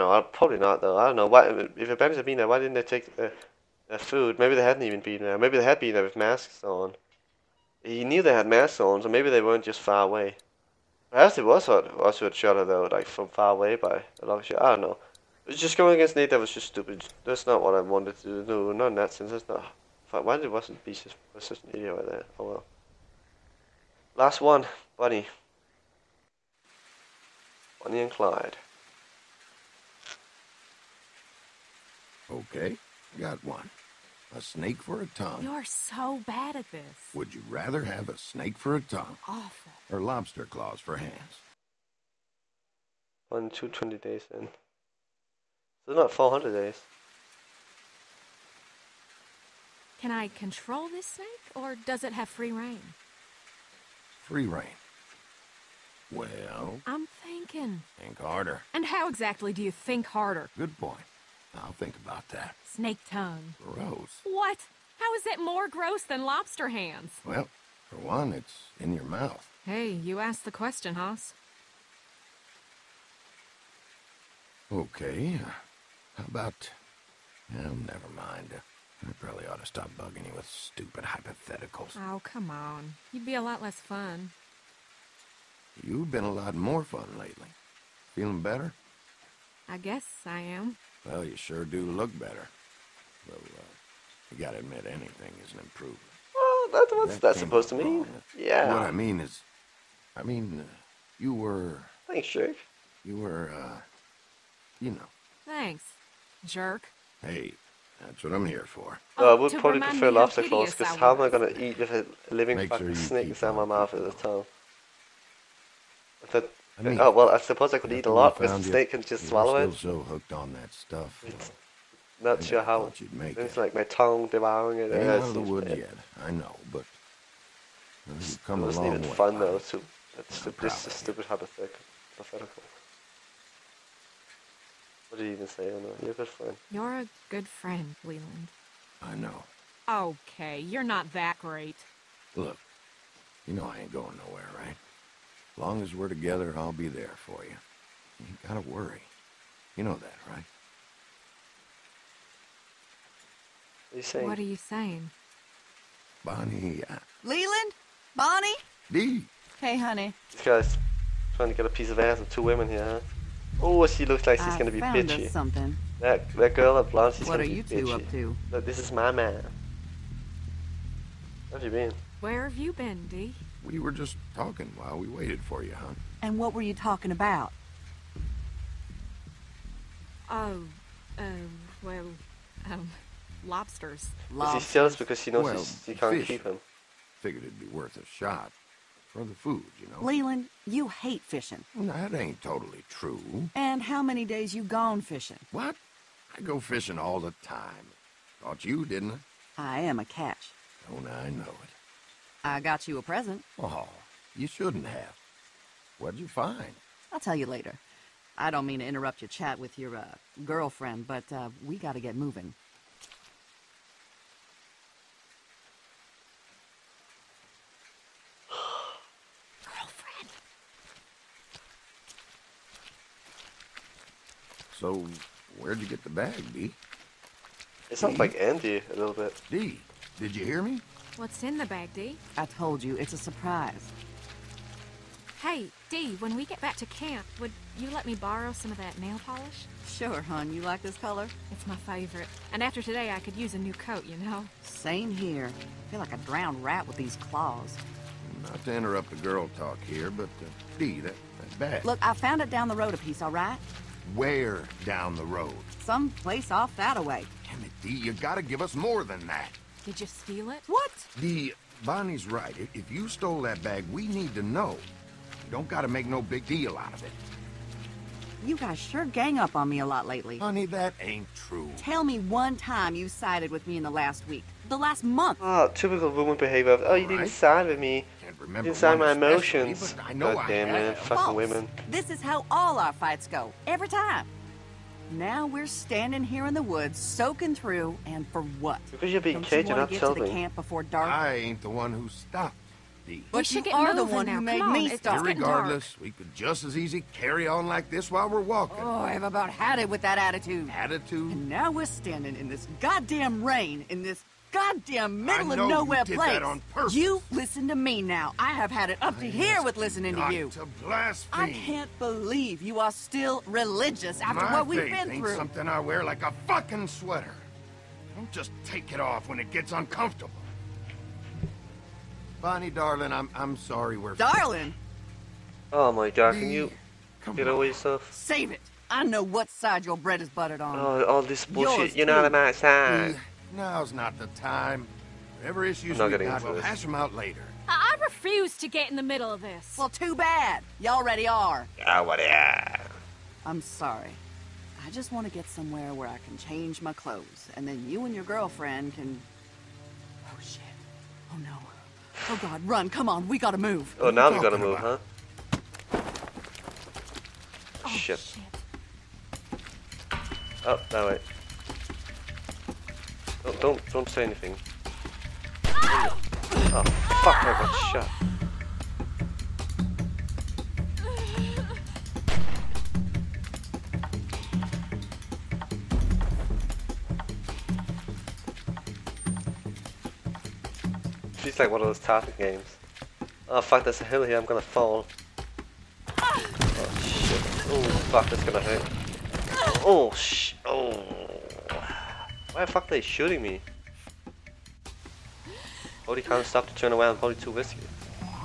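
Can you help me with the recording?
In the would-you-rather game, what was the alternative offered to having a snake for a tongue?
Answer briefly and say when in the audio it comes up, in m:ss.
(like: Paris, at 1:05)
Lobster claws for hands, at 0:40.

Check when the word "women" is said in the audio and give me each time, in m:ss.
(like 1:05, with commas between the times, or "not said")
2:42, 4:41.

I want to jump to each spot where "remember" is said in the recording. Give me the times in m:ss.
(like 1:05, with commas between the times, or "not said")
4:38.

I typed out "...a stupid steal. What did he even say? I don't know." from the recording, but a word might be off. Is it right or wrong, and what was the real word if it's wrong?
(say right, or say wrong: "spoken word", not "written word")
wrong: "hypothetical", not "steal".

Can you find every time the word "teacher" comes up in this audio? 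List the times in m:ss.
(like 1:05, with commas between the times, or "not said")
not said.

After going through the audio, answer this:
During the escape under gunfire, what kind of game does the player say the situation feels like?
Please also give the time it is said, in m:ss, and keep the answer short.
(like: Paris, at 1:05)
Target games, at 6:22.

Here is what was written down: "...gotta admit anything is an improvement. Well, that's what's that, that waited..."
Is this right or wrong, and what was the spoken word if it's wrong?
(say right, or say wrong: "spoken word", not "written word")
wrong: "supposed", not "waited".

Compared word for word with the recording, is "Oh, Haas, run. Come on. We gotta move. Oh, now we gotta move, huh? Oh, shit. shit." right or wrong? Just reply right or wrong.
wrong.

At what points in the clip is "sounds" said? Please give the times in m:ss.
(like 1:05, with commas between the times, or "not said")
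3:47.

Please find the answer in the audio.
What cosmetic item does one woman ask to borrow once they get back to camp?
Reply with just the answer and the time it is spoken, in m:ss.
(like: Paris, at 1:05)
Nail polish, at 3:58.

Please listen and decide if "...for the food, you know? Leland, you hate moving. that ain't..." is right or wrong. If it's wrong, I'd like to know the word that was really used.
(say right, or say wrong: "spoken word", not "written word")
wrong: "fishing", not "moving".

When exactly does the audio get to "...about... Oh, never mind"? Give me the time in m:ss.
1:16.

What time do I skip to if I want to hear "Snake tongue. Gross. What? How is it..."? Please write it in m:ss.
1:02.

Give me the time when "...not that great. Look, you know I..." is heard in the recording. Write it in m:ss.
2:20.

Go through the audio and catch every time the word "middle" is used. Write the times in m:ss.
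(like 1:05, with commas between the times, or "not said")
5:05, 5:39.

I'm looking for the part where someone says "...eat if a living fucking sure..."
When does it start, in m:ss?
1:51.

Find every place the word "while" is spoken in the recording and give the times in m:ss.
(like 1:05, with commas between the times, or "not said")
2:54, 4:58.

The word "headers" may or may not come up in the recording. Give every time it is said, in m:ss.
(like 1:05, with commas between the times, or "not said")
not said.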